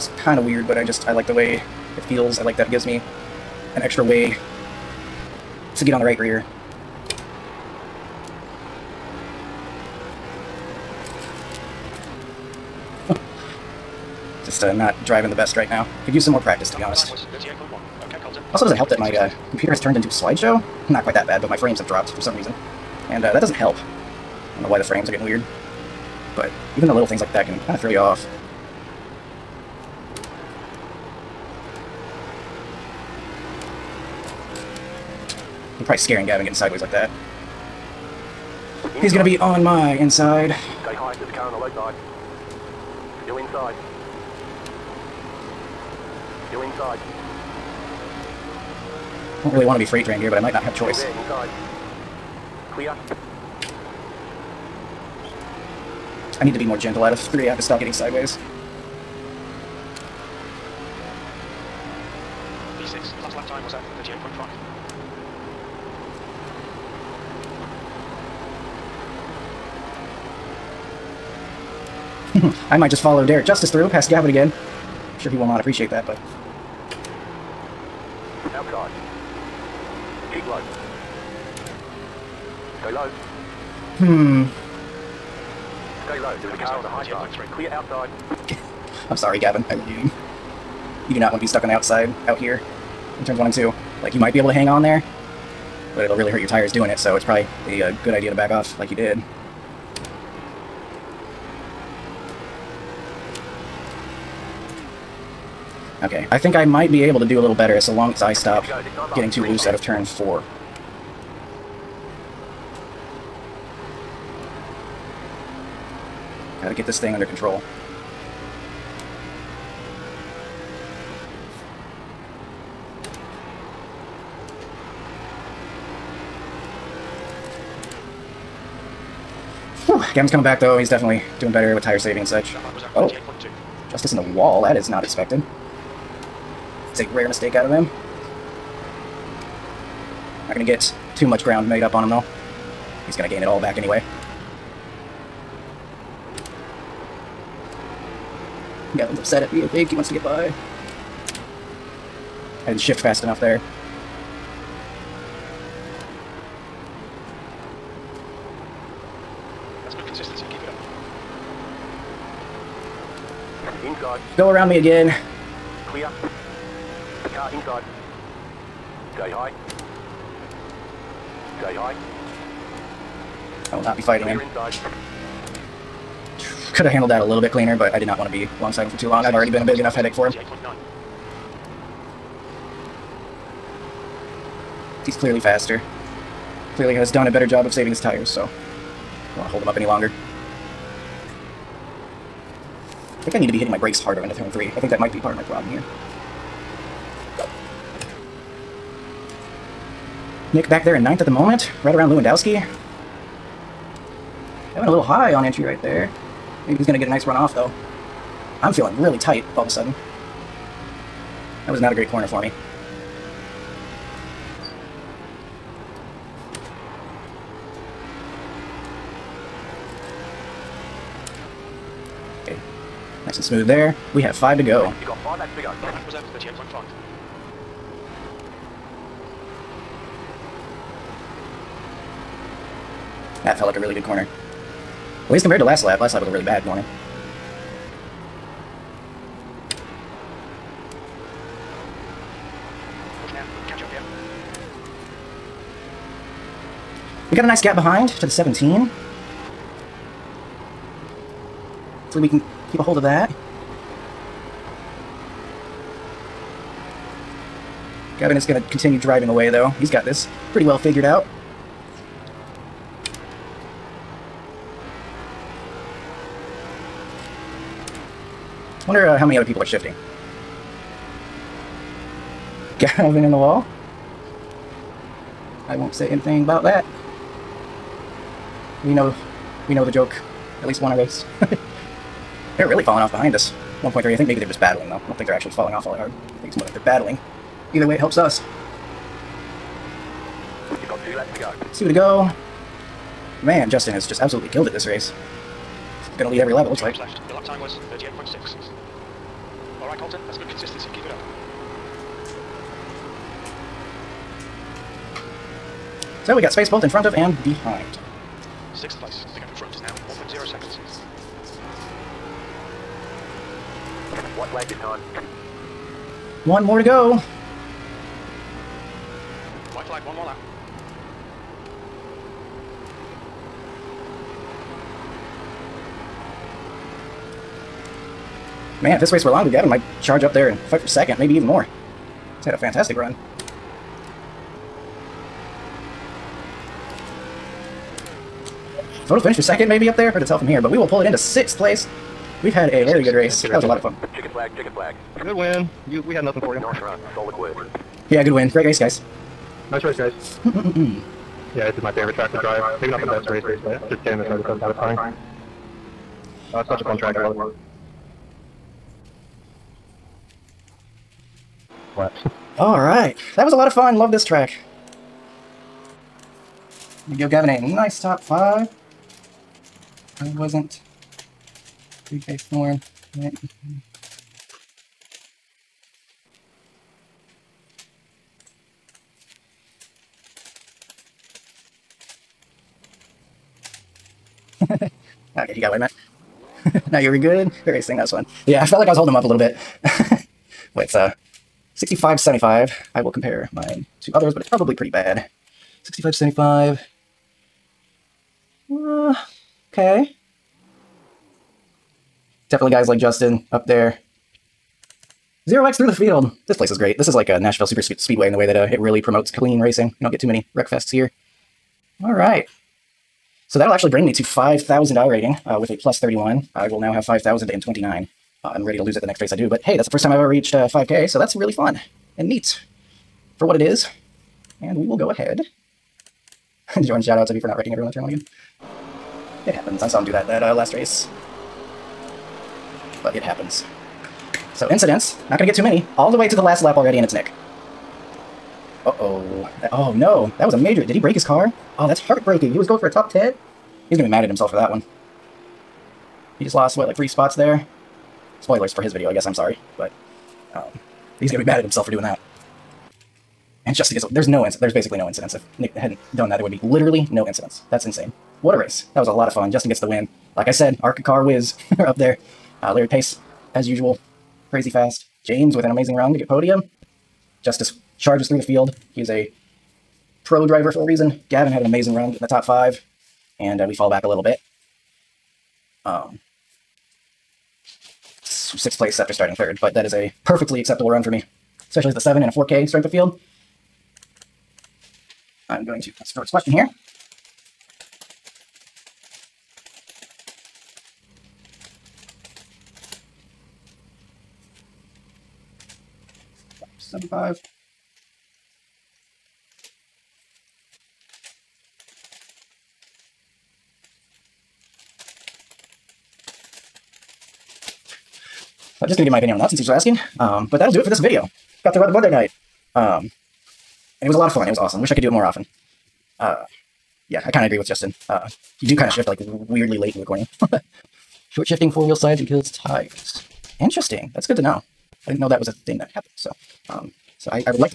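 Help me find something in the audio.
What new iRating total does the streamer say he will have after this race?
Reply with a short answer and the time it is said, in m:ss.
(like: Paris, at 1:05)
5,029, at 6:57.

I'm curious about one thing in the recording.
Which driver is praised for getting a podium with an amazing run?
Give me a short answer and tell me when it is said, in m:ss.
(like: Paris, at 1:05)
James, at 7:45.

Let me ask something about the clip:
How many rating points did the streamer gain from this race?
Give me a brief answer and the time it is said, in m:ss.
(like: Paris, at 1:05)
31, at 6:55.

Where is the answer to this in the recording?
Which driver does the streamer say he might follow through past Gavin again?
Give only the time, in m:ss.
1:13.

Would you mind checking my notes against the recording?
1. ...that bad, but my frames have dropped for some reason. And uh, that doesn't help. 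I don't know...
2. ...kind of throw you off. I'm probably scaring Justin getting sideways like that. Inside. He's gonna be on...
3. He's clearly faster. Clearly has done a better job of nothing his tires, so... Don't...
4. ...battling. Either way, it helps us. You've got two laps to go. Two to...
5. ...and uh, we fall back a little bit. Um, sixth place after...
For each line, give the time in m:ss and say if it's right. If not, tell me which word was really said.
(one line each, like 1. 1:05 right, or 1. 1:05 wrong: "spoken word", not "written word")
1. 0:21 right
2. 0:27 wrong: "Gavin", not "Justin"
3. 3:05 wrong: "saving", not "nothing"
4. 4:46 right
5. 7:53 right.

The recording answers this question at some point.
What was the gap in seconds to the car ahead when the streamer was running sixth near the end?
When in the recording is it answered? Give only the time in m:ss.
5:10.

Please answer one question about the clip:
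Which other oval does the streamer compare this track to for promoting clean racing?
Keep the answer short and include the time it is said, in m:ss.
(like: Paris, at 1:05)
Nashville Super Speedway, at 6:47.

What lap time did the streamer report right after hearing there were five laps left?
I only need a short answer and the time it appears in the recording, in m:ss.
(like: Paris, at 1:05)
38.5, at 3:46.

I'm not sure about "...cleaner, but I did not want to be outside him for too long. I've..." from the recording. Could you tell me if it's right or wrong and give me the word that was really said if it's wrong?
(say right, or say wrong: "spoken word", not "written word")
wrong: "alongside", not "outside".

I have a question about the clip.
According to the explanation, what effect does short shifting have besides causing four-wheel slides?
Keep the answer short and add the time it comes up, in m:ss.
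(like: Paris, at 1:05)
Kills tires, at 8:42.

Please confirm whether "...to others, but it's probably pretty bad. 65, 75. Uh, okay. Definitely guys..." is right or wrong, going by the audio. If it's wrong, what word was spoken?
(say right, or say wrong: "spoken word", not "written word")
right.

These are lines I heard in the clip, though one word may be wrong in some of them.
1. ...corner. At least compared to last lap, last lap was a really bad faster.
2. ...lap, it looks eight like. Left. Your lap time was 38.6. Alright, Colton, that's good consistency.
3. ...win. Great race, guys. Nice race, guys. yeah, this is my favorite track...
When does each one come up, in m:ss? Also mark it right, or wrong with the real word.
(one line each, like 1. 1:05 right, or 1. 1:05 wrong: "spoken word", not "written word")
1. 3:54 wrong: "corner", not "faster"
2. 4:56 wrong: "two", not "eight"
3. 5:48 right.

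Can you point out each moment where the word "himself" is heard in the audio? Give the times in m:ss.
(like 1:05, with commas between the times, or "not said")
7:24, 7:31.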